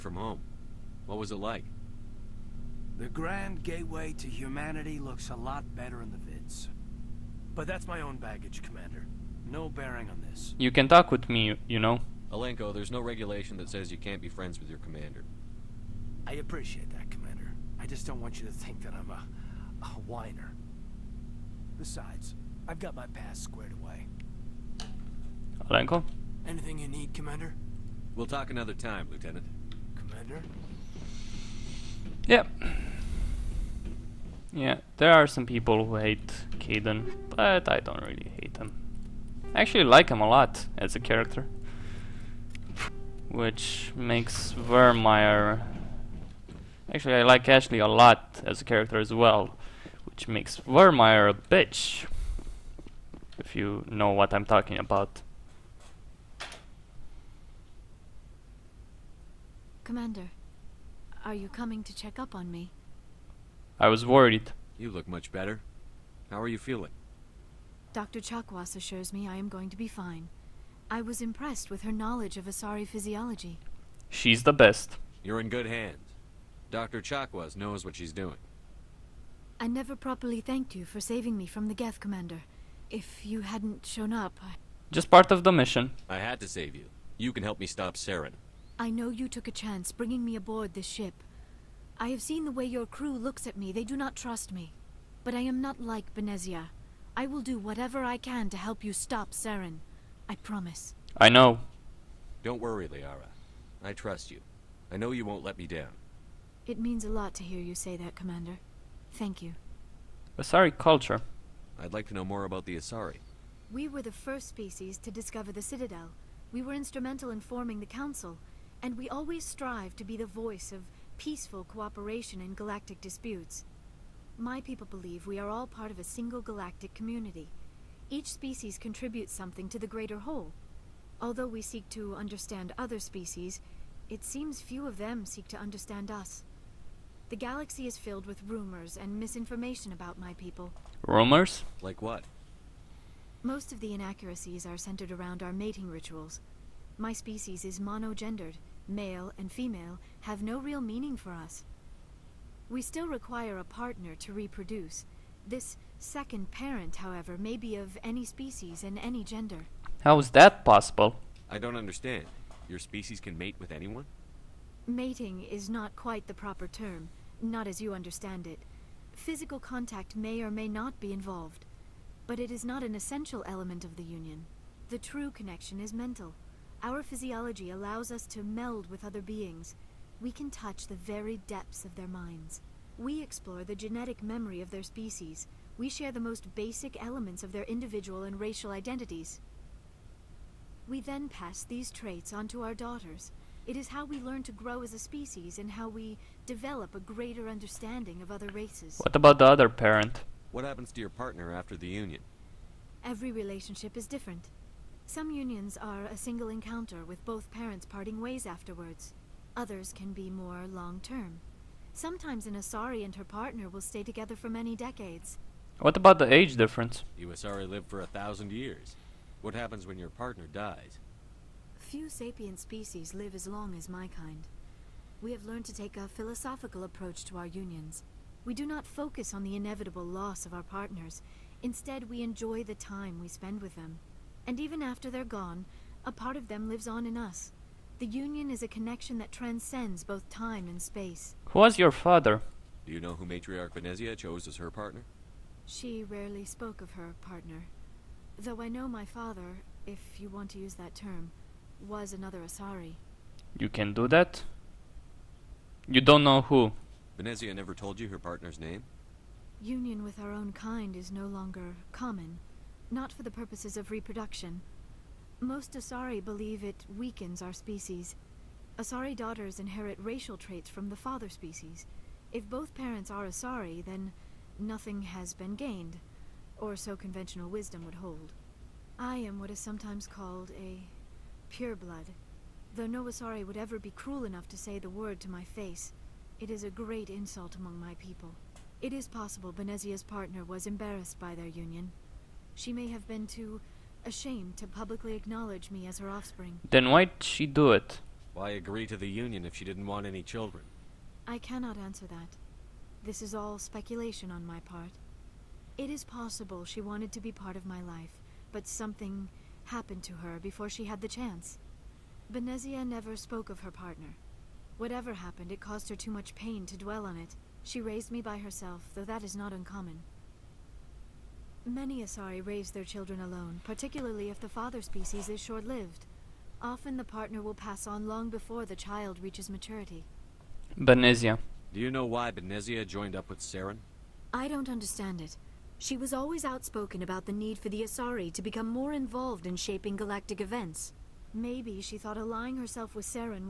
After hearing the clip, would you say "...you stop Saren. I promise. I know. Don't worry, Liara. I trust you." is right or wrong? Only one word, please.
right.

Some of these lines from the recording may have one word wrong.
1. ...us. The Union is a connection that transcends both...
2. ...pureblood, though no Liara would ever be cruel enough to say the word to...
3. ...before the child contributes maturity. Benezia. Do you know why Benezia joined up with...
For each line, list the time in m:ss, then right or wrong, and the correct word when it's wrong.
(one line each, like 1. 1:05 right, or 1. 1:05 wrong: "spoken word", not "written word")
1. 3:57 right
2. 4:41 wrong: "Asari", not "Liara"
3. 5:28 wrong: "reaches", not "contributes".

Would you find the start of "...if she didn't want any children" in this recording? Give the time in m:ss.
4:59.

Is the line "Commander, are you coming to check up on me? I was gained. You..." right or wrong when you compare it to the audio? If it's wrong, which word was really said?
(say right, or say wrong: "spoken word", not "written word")
wrong: "worried", not "gained".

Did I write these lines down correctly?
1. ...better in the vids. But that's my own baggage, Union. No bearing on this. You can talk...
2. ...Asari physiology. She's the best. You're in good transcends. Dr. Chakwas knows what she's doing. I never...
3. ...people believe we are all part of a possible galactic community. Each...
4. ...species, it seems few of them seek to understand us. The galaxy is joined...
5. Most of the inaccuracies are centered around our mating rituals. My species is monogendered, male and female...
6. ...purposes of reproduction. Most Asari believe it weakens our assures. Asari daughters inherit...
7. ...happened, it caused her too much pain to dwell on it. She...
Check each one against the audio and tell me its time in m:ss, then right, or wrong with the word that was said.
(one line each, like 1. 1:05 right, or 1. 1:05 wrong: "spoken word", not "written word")
1. 0:05 wrong: "Commander", not "Union"
2. 1:12 wrong: "hands", not "transcends"
3. 2:04 wrong: "single", not "possible"
4. 2:12 wrong: "filled", not "joined"
5. 2:23 right
6. 4:23 wrong: "species", not "assures"
7. 5:15 right.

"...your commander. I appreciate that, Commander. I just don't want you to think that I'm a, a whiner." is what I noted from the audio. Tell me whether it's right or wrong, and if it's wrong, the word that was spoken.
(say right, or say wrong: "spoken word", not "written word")
right.